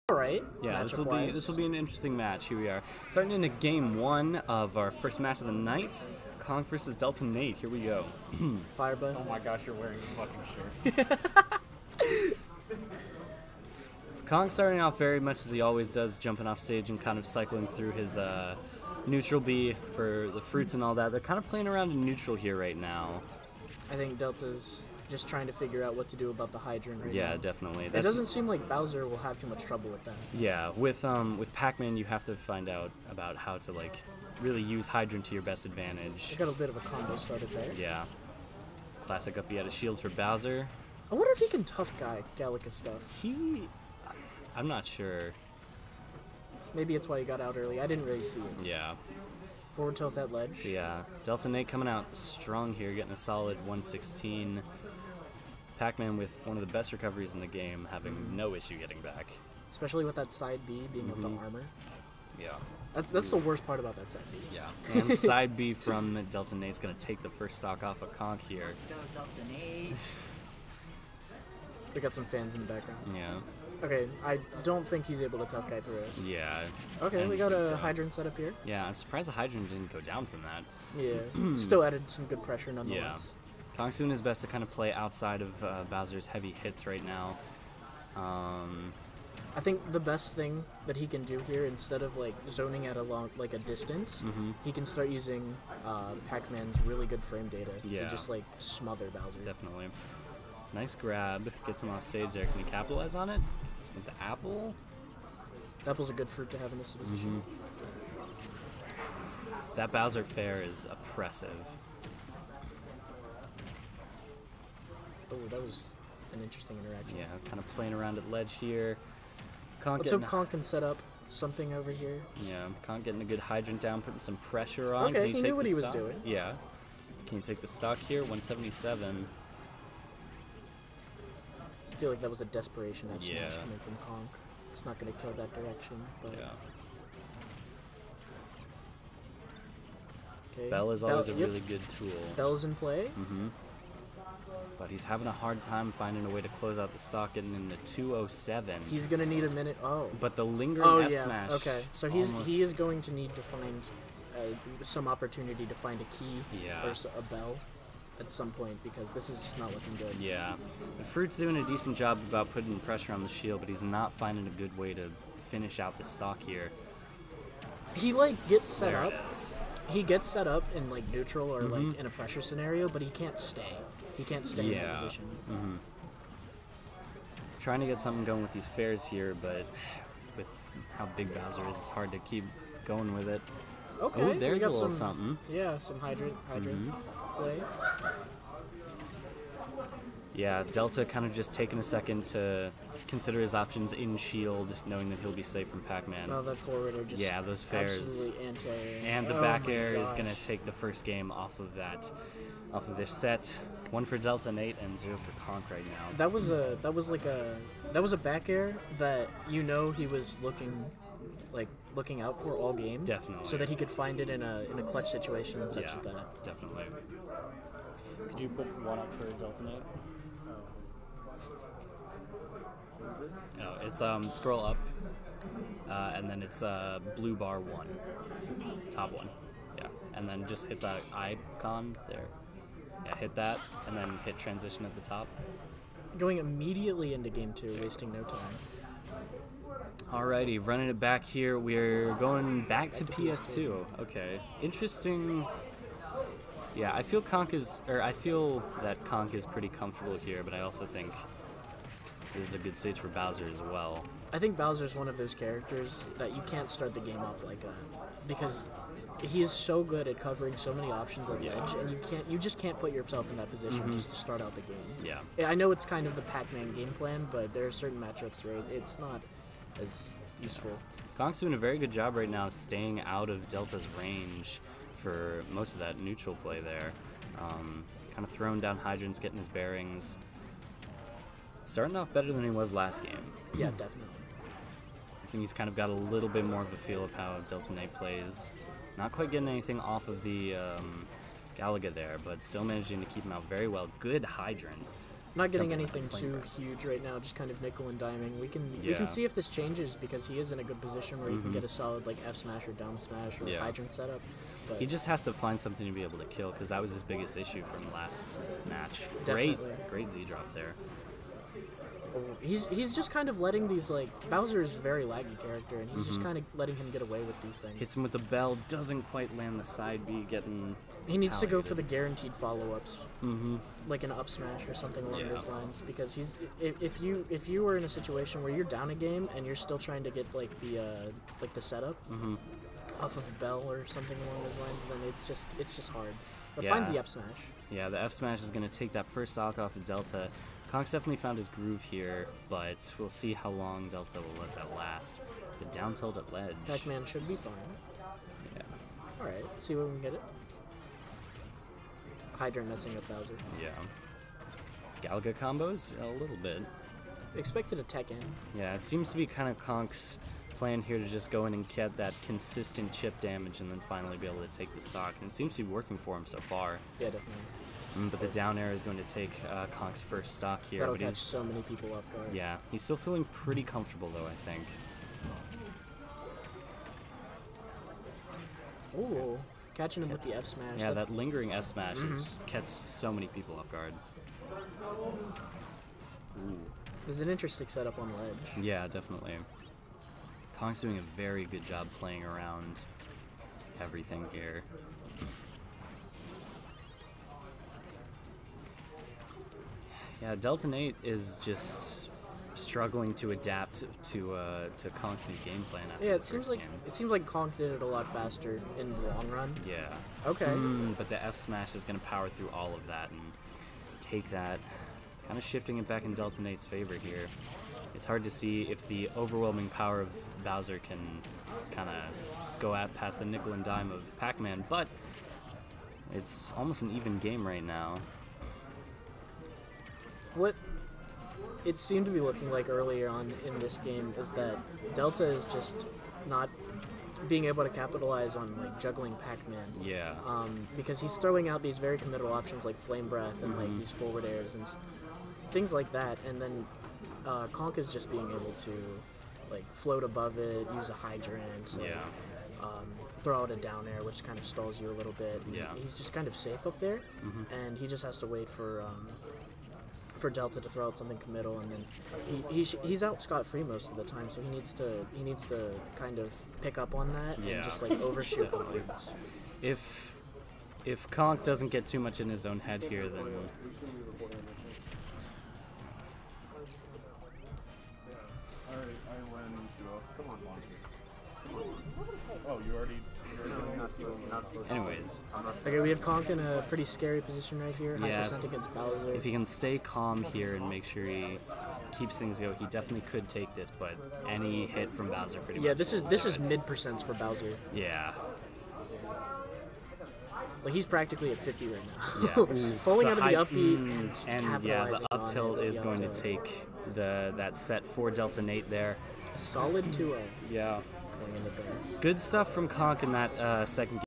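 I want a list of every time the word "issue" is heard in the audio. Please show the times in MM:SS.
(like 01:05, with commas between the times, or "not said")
00:58, 05:07.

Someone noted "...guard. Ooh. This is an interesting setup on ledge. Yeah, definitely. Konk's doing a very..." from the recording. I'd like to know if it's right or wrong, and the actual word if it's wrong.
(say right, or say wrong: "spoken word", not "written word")
right.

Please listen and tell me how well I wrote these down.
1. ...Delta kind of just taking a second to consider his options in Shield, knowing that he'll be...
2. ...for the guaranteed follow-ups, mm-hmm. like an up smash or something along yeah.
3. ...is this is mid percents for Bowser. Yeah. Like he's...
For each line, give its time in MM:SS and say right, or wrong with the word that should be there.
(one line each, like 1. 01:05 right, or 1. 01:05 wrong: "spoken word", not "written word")
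1. 03:10 right
2. 05:21 right
3. 08:15 right.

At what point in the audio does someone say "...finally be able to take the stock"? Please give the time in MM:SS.
06:03.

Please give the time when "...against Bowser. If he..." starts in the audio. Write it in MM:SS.
08:08.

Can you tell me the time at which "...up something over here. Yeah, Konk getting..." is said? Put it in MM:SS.
02:00.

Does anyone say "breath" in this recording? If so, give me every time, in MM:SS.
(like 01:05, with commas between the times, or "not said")
04:56, 07:23.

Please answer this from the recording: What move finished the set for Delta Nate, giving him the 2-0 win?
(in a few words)
Up tilt.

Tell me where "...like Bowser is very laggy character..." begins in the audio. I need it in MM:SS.
05:13.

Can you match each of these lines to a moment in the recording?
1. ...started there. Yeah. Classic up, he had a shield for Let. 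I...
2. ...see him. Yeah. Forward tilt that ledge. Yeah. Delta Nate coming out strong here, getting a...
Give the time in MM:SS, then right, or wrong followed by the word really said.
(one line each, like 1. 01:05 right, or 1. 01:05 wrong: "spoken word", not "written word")
1. 00:37 wrong: "Bowser", not "Let"
2. 00:48 right.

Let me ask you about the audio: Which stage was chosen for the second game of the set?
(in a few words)
PS2.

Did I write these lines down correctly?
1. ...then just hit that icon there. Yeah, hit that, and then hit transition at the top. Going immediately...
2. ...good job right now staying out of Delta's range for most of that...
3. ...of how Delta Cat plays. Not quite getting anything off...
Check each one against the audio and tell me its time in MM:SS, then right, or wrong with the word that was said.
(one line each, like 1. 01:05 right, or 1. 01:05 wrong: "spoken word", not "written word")
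1. 03:50 right
2. 04:31 right
3. 04:47 wrong: "Knight", not "Cat".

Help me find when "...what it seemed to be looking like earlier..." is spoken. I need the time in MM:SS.
07:10.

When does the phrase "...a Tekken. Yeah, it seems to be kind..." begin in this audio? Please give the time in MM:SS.
05:57.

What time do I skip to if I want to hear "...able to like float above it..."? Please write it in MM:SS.
07:28.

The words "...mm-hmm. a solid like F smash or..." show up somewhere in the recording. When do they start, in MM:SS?
05:01.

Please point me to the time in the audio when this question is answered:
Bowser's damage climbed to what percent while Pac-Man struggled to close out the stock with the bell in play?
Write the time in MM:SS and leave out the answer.
02:27.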